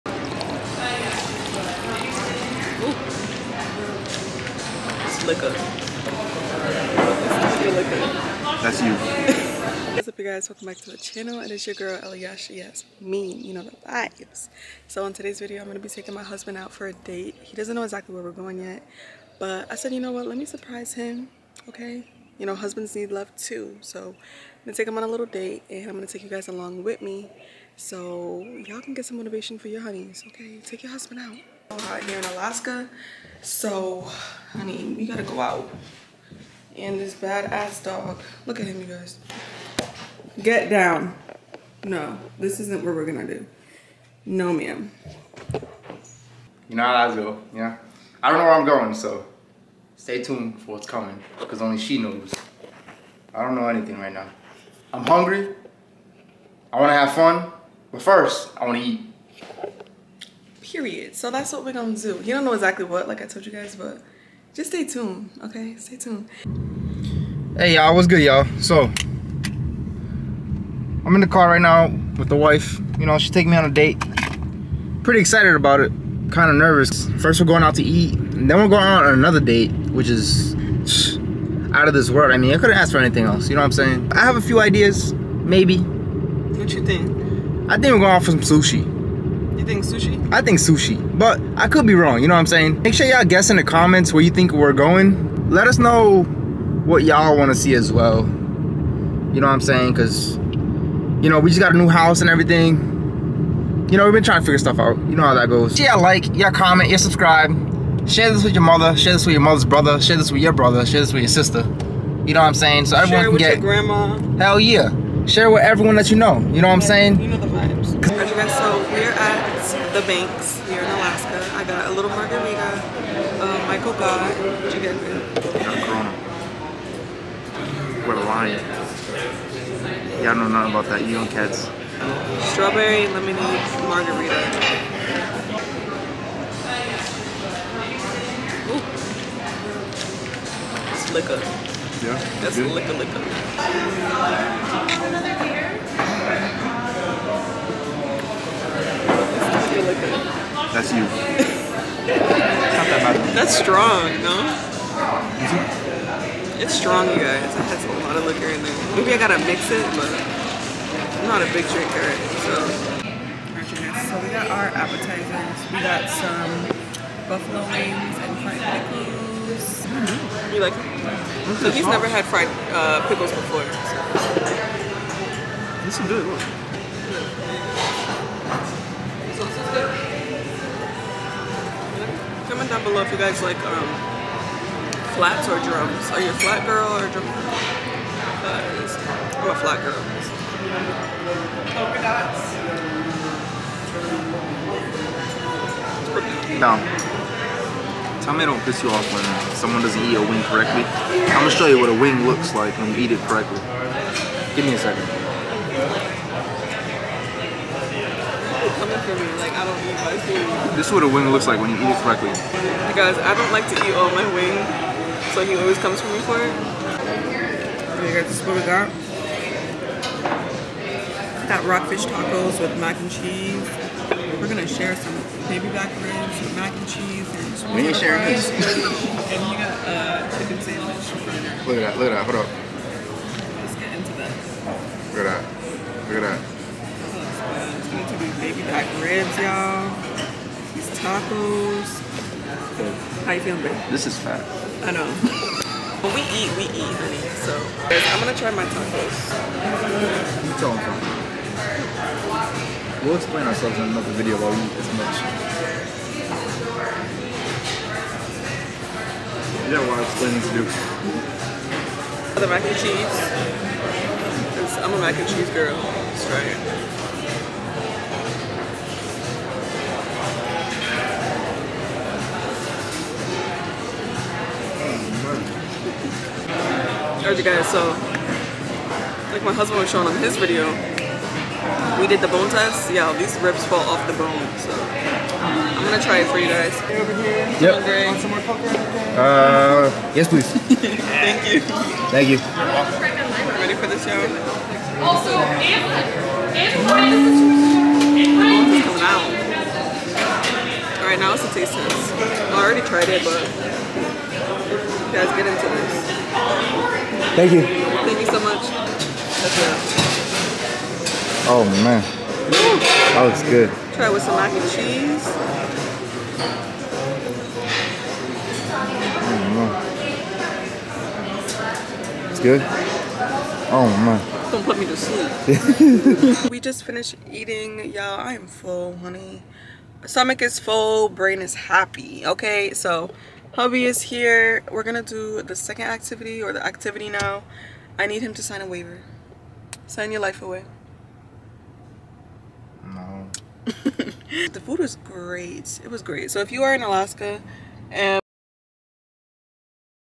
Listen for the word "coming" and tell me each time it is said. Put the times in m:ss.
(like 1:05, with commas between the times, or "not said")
0:50, 3:28, 4:58.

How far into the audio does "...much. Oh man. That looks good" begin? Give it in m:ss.
5:08.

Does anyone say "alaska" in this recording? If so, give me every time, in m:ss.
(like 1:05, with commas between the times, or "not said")
0:32, 2:00, 5:46.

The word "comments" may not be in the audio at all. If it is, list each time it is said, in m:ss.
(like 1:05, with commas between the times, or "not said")
1:33, 1:46.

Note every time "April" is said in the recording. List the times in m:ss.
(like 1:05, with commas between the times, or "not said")
not said.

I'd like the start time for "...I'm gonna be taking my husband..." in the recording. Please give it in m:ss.
0:15.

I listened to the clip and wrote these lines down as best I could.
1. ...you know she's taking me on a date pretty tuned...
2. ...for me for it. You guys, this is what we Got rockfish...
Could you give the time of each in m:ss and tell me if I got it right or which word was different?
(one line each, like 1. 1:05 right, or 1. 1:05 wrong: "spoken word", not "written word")
1. 1:12 wrong: "excited", not "tuned"
2. 3:36 right.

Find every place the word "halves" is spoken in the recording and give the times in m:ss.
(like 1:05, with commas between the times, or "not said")
not said.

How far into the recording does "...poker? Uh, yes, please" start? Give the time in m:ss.
4:48.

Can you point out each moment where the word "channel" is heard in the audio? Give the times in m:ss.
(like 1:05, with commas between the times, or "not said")
0:10.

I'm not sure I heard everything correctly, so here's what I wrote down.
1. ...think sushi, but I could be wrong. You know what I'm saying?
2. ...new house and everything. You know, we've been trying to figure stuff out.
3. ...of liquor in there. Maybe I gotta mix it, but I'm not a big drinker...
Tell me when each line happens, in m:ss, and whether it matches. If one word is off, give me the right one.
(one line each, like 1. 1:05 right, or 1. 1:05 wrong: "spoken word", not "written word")
1. 1:30 right
2. 1:41 right
3. 2:38 right.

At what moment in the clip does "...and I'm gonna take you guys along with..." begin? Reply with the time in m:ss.
0:25.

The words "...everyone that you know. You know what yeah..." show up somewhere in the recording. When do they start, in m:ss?
1:55.